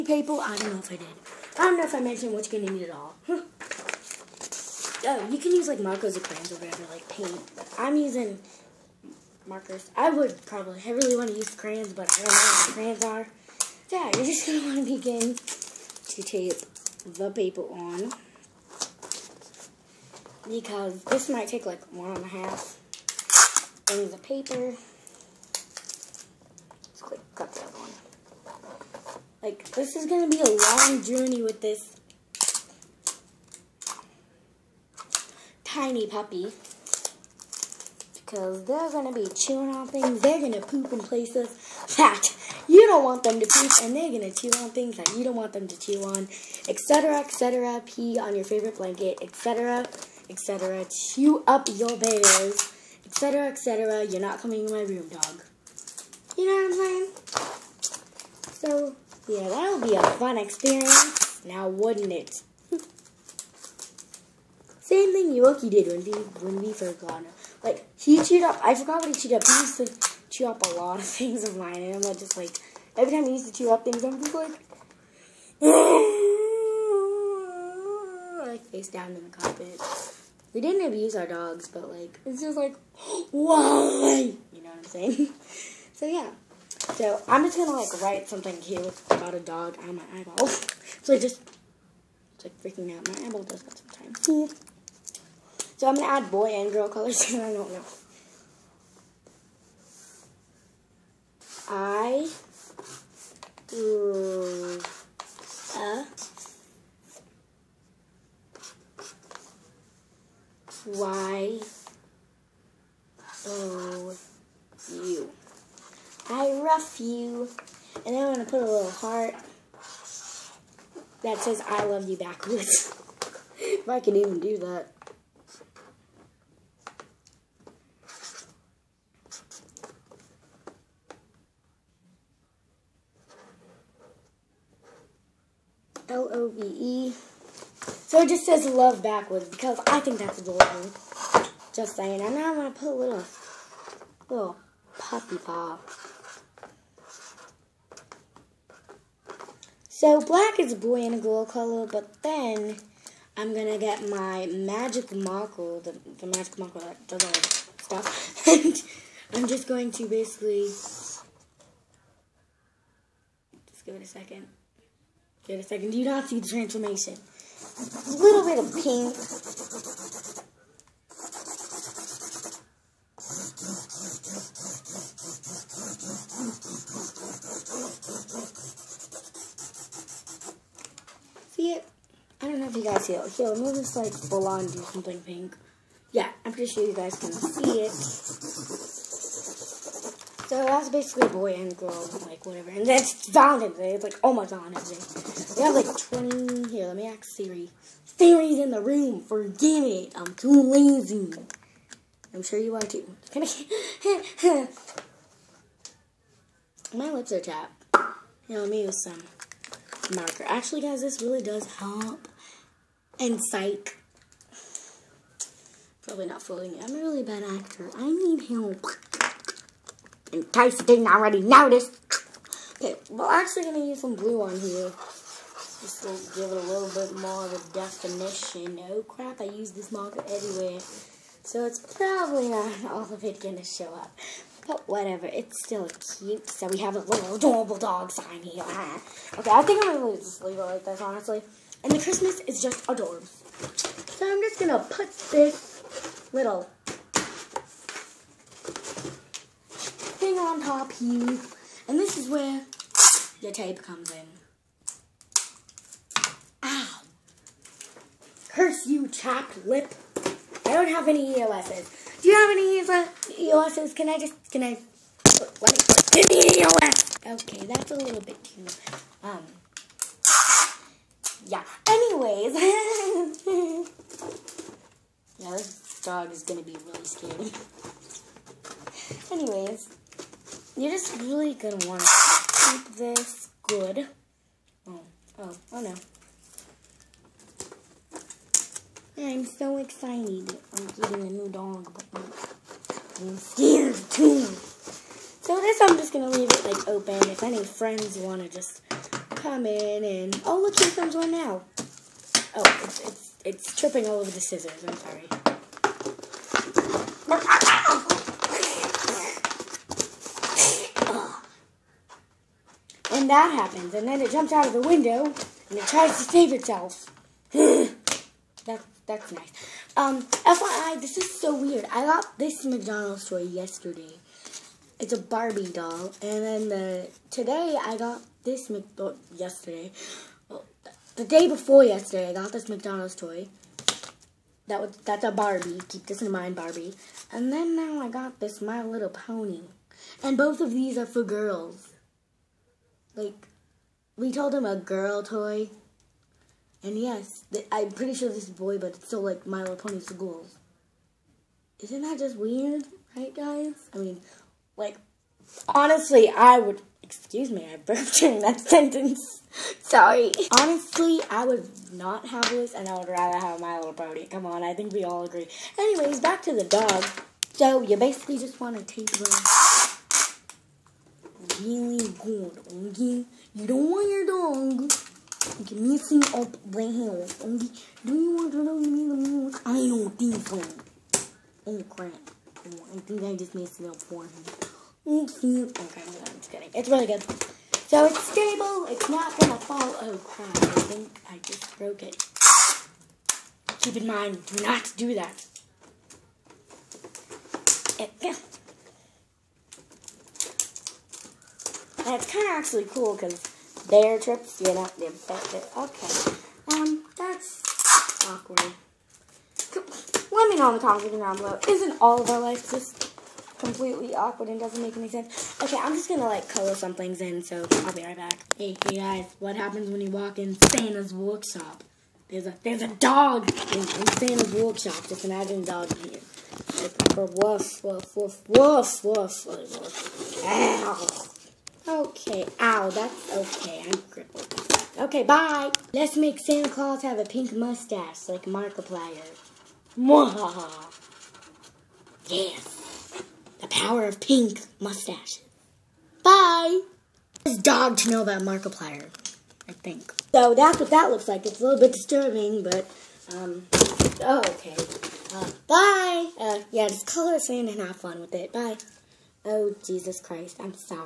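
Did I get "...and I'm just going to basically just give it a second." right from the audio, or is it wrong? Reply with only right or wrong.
right.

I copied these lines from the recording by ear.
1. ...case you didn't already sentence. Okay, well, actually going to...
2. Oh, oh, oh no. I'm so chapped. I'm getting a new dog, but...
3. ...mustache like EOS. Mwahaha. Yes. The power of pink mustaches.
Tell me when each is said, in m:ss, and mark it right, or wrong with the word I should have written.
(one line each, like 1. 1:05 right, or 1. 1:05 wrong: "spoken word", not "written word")
1. 3:40 wrong: "notice", not "sentence"
2. 4:44 wrong: "excited", not "chapped"
3. 7:17 wrong: "Markiplier", not "EOS".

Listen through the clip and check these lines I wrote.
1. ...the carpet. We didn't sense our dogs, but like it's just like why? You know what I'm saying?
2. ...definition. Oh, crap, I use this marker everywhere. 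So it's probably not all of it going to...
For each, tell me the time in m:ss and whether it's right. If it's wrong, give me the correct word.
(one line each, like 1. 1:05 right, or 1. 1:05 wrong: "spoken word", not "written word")
1. 1:19 wrong: "abuse", not "sense"
2. 3:47 right.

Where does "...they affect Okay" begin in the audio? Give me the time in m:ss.
6:44.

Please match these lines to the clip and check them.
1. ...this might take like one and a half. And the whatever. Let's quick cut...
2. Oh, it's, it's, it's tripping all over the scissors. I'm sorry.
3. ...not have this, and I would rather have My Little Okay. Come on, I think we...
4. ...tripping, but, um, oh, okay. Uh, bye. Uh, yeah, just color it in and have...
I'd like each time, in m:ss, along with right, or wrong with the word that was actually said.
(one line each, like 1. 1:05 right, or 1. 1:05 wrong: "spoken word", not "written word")
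1. 0:21 wrong: "paper", not "whatever"
2. 5:02 right
3. 6:01 wrong: "Pony", not "Okay"
4. 7:31 wrong: "disturbing", not "tripping".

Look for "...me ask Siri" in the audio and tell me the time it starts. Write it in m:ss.
3:16.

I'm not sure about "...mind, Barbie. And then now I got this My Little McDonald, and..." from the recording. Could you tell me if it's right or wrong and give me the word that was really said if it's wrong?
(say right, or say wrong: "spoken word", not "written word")
wrong: "Pony", not "McDonald".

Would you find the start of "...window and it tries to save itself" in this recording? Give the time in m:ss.
5:14.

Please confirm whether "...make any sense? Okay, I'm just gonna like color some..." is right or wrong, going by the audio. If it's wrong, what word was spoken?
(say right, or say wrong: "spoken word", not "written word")
right.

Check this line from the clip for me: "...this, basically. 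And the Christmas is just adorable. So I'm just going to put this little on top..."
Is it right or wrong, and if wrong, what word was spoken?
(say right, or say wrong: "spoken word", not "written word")
wrong: "honestly", not "basically".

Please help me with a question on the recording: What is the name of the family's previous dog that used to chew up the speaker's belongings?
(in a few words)
Yoki.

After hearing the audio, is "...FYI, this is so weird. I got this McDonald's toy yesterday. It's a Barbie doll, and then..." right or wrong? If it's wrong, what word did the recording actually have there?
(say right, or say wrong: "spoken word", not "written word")
right.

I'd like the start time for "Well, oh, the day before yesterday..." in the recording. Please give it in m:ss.
5:30.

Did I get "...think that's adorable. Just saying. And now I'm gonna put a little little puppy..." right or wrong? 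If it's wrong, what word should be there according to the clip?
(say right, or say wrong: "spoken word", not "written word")
right.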